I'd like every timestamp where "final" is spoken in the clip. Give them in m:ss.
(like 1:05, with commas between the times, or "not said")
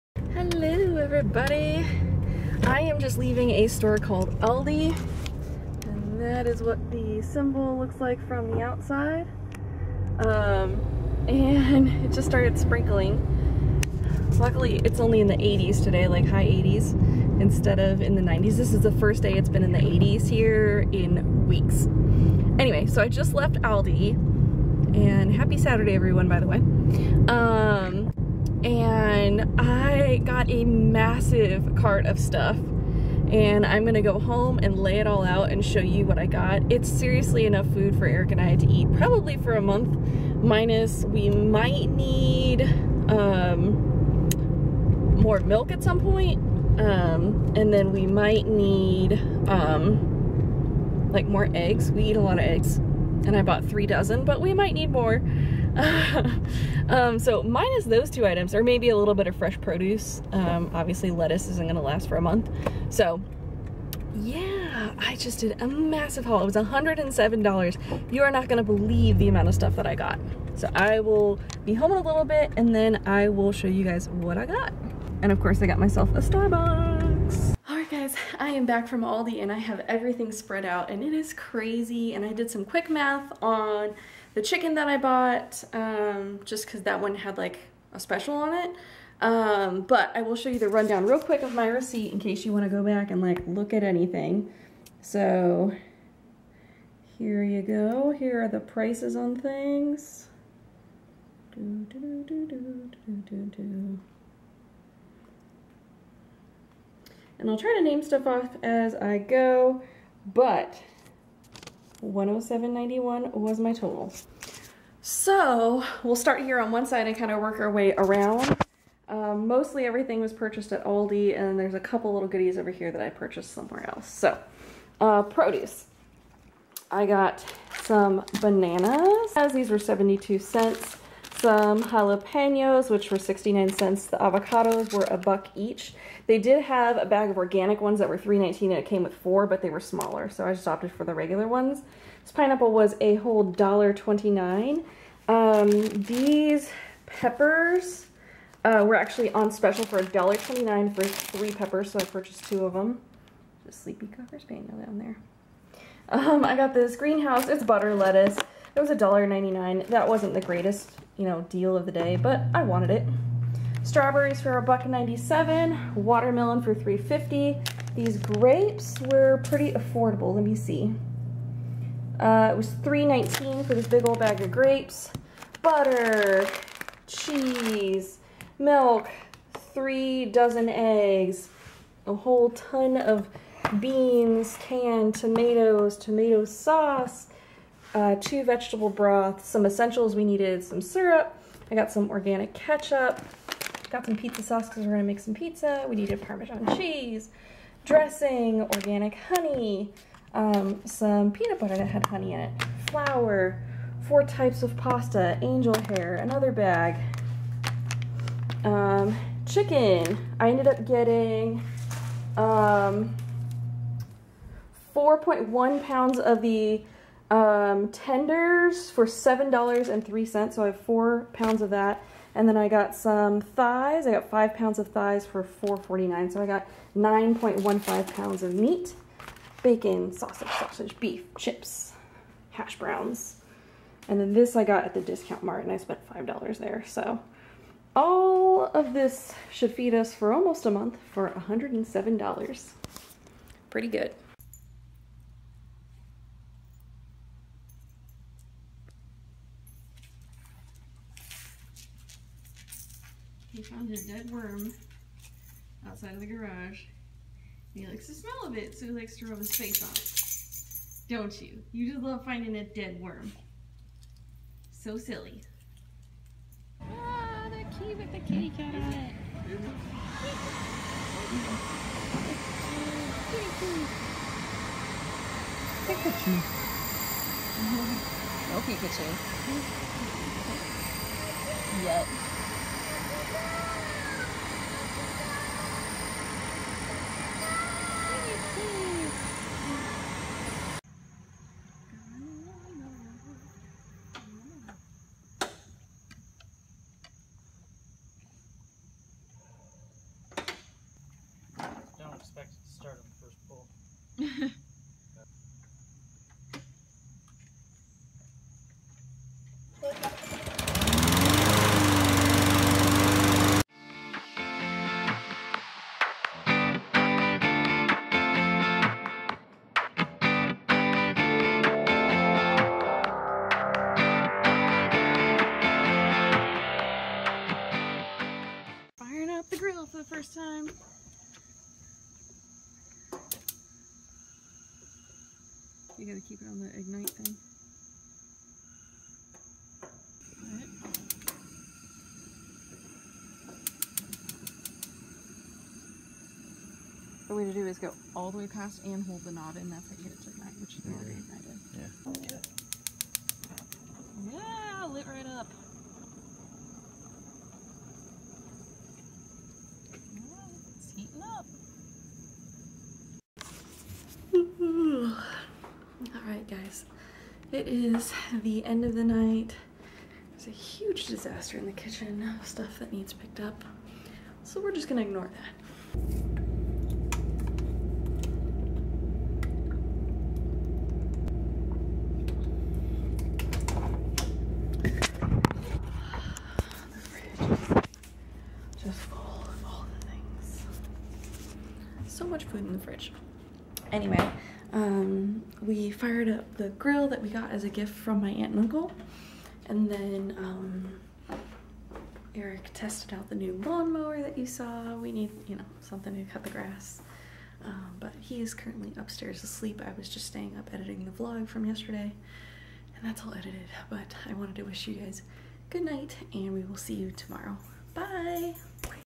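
not said.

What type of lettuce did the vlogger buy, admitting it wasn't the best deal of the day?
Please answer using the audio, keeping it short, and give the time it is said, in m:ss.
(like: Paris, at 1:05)
Butter lettuce, at 2:37.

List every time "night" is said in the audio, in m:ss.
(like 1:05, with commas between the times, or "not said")
6:09, 6:55.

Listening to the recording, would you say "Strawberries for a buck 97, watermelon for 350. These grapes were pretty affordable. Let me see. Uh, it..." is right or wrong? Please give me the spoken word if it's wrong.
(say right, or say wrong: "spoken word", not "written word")
right.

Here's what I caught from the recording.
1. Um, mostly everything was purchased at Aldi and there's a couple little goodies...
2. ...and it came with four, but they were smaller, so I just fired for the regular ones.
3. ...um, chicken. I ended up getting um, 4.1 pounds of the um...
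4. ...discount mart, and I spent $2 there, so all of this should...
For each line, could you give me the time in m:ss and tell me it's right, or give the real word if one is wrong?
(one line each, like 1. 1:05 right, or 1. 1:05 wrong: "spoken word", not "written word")
1. 1:59 right
2. 2:18 wrong: "opted", not "fired"
3. 3:28 right
4. 3:55 wrong: "5", not "2".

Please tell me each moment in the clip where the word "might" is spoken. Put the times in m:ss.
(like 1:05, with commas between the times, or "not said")
0:41, 0:48, 0:54.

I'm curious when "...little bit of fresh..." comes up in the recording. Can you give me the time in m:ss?
0:58.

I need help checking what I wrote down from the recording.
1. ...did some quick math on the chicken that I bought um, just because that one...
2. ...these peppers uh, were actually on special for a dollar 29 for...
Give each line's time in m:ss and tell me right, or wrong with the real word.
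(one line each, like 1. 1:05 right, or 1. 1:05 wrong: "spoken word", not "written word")
1. 1:22 right
2. 2:25 right.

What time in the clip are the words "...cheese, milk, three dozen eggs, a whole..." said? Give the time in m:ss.
2:57.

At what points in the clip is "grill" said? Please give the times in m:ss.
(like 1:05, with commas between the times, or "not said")
5:29, 6:36.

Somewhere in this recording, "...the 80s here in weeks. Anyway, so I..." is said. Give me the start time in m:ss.
0:19.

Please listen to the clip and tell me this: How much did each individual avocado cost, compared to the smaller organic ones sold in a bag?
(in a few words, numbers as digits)
$1.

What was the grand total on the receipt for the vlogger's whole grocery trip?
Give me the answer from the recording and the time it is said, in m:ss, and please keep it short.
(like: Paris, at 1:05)
$107.91, at 1:52.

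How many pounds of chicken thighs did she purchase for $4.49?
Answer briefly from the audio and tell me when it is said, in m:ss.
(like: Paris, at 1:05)
5 pounds, at 3:44.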